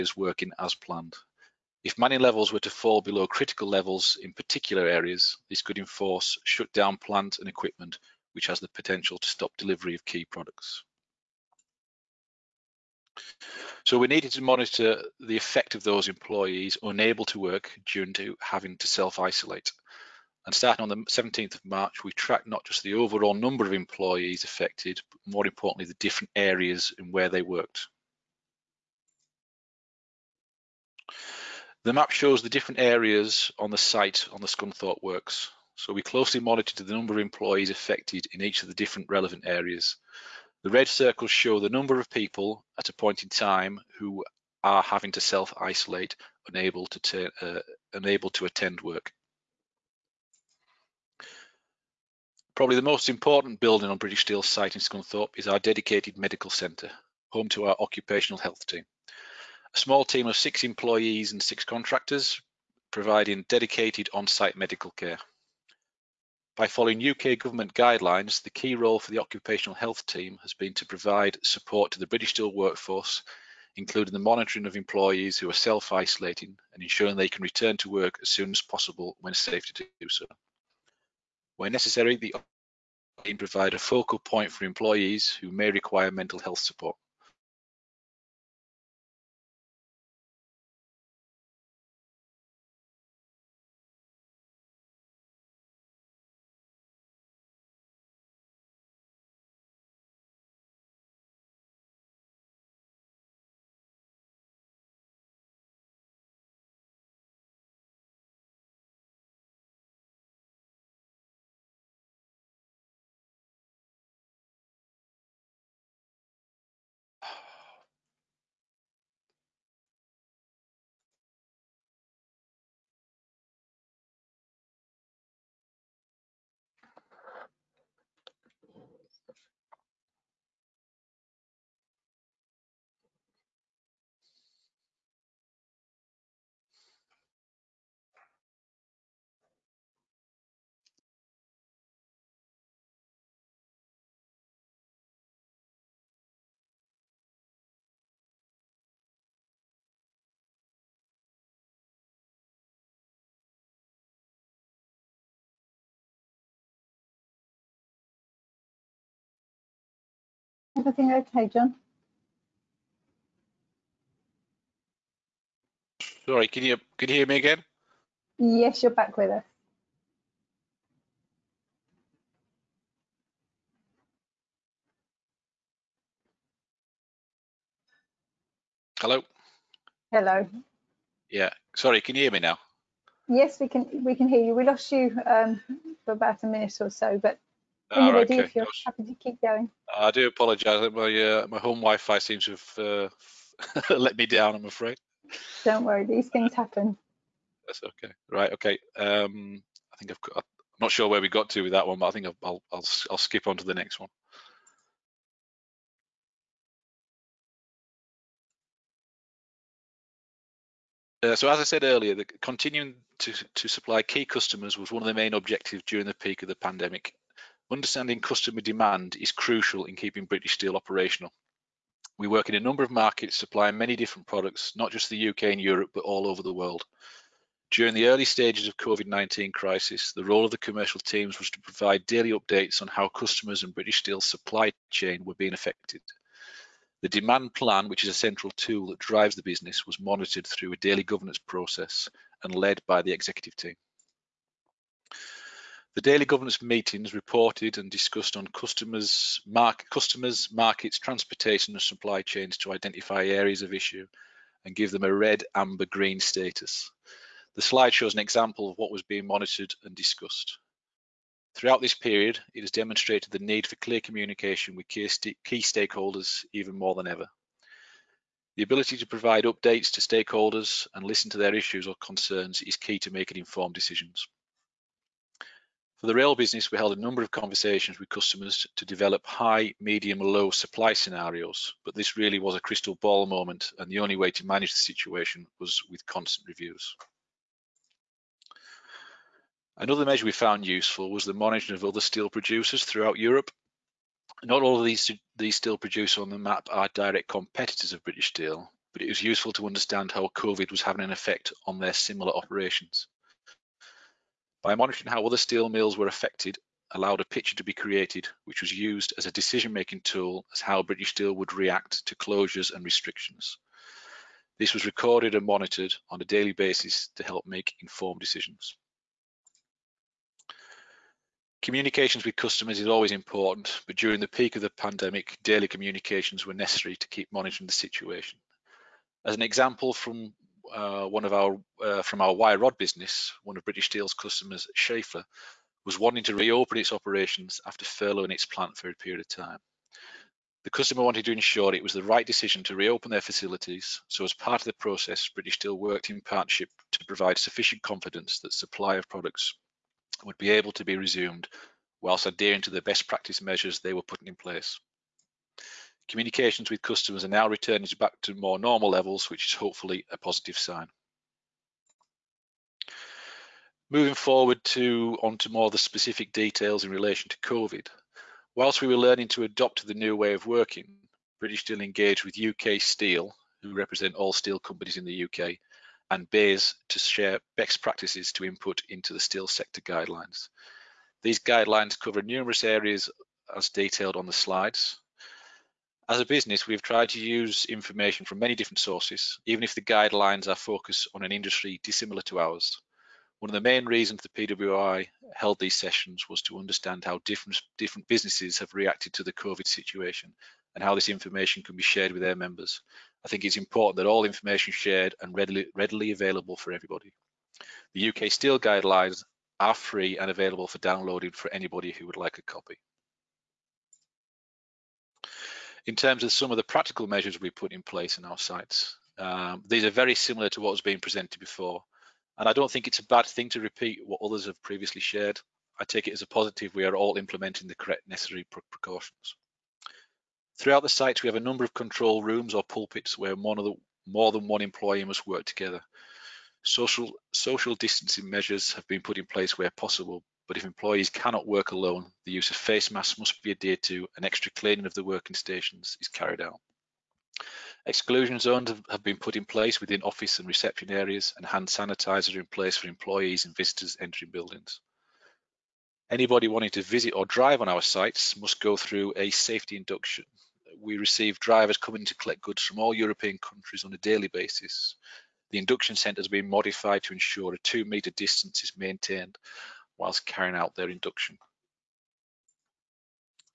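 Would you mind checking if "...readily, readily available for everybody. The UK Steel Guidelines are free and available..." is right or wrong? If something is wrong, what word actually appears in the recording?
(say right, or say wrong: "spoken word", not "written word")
right.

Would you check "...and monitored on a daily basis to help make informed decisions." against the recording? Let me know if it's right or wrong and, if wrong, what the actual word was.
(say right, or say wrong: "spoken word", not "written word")
right.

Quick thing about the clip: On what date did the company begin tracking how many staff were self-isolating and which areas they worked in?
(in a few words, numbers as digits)
17th of March.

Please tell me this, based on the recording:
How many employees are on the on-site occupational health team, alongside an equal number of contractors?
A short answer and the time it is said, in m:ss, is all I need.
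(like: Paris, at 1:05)
6, at 1:00.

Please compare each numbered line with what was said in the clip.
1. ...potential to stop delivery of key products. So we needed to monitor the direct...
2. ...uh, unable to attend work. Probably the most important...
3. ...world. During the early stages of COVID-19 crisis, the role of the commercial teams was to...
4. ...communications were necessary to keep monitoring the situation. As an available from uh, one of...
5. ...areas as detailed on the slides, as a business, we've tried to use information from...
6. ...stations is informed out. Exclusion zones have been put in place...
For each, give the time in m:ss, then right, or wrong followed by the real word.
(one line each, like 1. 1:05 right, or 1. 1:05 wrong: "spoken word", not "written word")
1. 0:08 wrong: "effect", not "direct"
2. 0:47 right
3. 3:46 right
4. 5:25 wrong: "example", not "available"
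5. 6:22 right
6. 7:25 wrong: "carried", not "informed".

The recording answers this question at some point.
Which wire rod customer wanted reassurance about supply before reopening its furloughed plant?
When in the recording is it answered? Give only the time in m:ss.
5:34.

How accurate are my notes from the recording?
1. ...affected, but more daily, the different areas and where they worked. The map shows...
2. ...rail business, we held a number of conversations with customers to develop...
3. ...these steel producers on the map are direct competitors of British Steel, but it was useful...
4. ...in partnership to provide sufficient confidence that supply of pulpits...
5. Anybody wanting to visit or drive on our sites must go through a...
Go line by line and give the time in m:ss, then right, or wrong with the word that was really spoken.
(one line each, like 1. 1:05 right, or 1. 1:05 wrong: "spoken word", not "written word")
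1. 0:24 wrong: "importantly", not "daily"
2. 4:36 right
3. 4:55 right
4. 5:46 wrong: "products", not "pulpits"
5. 7:36 right.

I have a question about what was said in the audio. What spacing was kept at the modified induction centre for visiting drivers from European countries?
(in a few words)
2 metres.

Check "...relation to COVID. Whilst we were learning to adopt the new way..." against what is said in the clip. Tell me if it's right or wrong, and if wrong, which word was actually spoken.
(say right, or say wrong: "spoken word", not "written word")
right.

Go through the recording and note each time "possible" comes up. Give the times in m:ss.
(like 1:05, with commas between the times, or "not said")
1:18, 7:19.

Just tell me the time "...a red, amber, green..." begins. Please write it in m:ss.
4:15.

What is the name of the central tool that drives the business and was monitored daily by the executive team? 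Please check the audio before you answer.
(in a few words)
The demand plan.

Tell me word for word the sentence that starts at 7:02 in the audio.
And I don't think it's a bad thing to repeat what others have previously shared.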